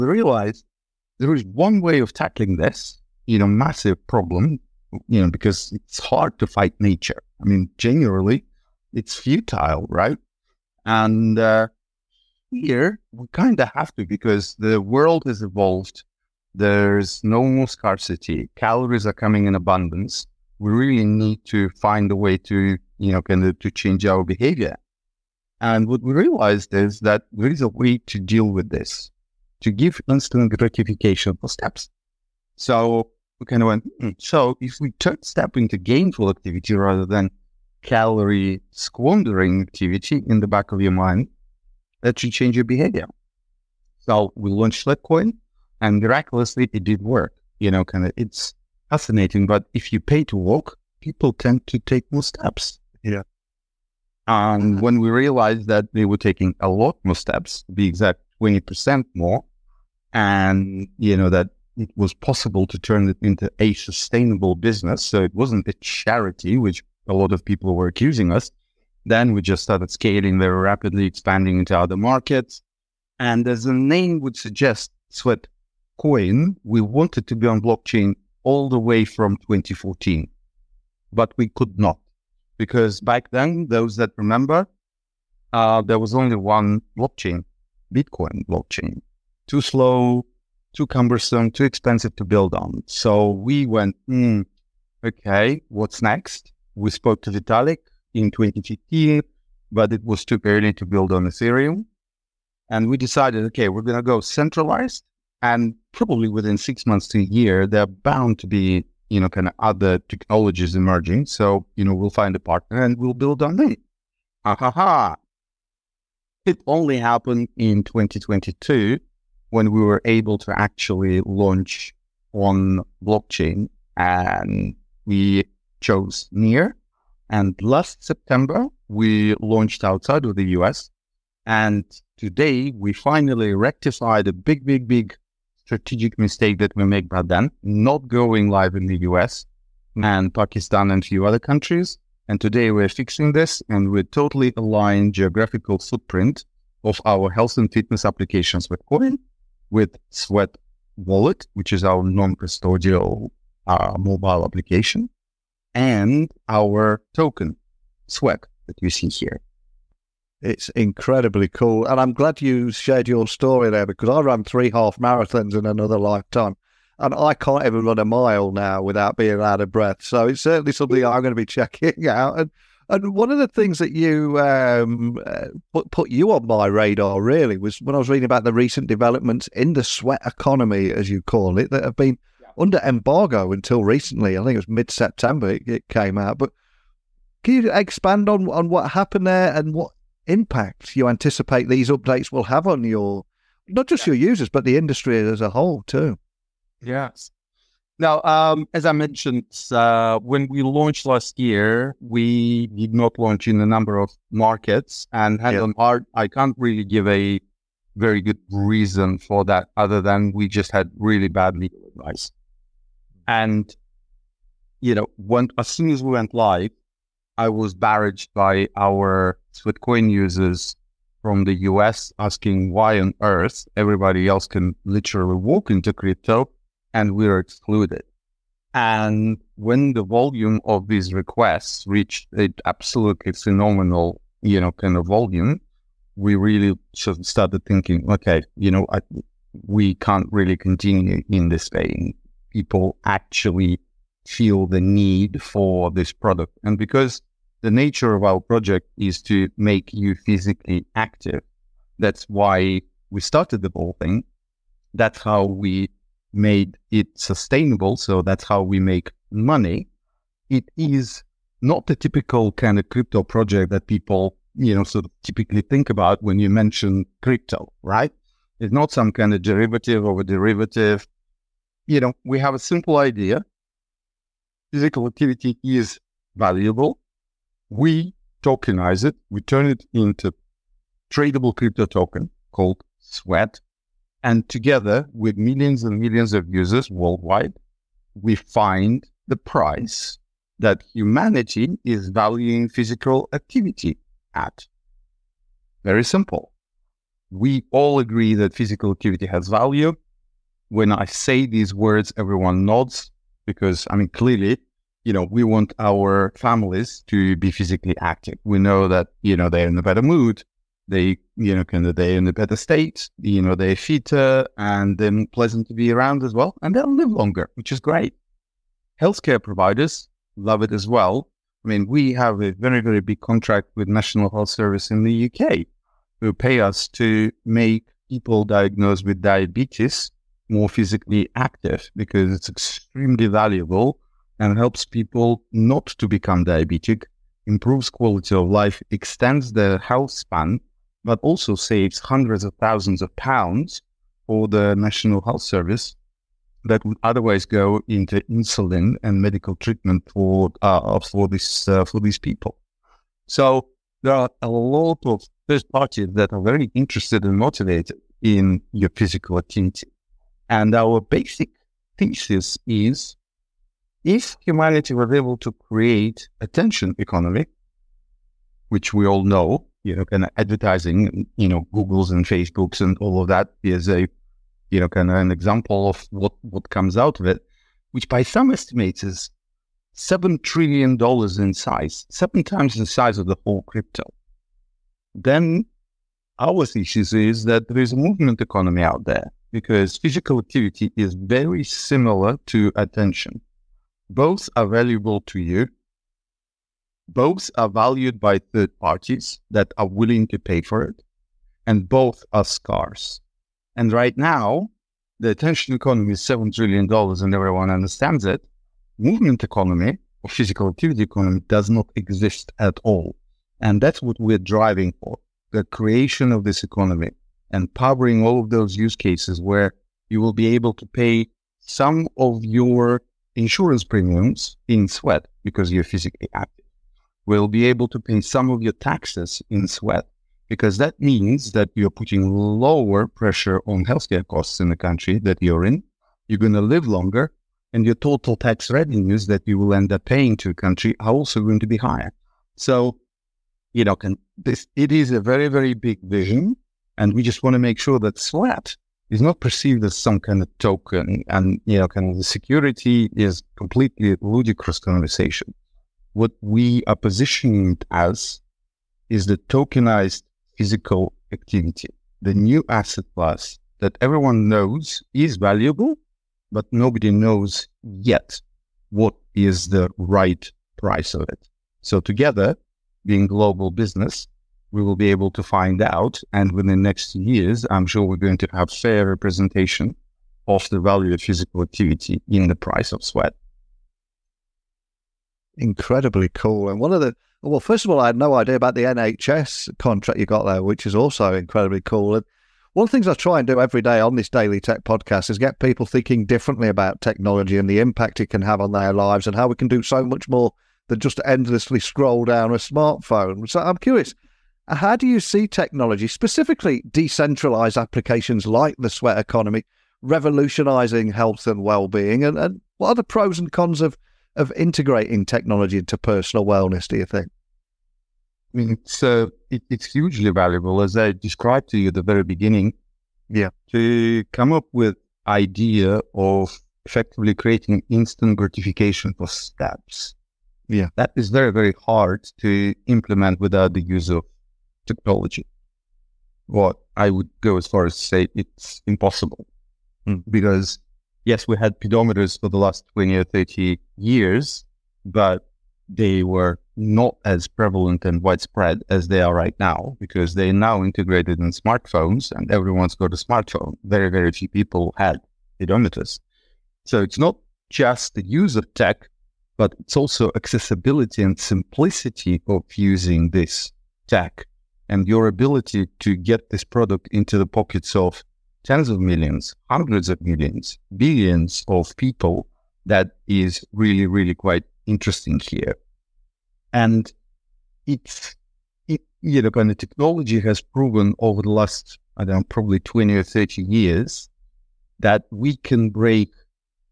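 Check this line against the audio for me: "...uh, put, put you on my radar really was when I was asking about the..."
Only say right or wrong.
wrong.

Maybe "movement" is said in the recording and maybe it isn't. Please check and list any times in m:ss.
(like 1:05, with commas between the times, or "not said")
6:27, 6:48.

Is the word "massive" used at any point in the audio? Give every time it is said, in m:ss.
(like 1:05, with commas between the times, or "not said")
0:03.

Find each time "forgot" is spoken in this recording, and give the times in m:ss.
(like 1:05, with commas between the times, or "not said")
not said.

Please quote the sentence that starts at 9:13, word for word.
Very, very few people had pedometers.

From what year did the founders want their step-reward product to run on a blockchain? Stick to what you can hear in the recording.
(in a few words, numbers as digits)
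2014.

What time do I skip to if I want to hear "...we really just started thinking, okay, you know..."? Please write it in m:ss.
3:56.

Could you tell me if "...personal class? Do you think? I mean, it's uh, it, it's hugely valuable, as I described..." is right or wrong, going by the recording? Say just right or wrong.
wrong.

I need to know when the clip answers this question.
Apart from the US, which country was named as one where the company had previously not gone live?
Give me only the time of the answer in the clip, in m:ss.
2:20.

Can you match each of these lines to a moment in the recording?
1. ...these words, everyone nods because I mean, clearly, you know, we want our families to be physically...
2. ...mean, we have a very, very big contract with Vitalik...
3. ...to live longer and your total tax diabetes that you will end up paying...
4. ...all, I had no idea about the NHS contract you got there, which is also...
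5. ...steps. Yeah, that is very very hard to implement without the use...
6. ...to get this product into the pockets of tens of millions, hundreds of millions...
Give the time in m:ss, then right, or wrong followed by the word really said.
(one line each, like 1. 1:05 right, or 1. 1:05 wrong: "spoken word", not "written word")
1. 5:01 right
2. 5:21 wrong: "National", not "Vitalik"
3. 7:16 wrong: "revenues", not "diabetes"
4. 8:07 right
5. 8:49 right
6. 9:25 right.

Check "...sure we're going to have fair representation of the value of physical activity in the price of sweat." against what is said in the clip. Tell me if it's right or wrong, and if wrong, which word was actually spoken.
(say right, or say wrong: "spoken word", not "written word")
right.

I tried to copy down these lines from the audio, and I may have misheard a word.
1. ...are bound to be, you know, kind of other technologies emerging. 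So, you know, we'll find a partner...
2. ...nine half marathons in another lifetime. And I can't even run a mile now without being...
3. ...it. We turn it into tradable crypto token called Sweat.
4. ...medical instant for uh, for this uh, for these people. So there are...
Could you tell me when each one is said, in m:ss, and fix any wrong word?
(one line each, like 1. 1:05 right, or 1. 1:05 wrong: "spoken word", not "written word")
1. 1:47 right
2. 2:44 wrong: "three", not "nine"
3. 4:39 right
4. 5:49 wrong: "treatment", not "instant".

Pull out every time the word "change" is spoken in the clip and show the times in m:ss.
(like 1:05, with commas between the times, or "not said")
0:23, 0:42.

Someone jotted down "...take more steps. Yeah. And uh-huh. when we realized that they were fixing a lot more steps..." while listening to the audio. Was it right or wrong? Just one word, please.
wrong.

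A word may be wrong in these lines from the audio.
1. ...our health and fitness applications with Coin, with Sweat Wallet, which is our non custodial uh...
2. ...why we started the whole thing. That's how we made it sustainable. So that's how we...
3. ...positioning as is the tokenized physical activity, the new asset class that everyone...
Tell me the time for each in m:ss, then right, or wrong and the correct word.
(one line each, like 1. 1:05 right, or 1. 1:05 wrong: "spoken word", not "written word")
1. 2:27 right
2. 4:12 right
3. 7:36 right.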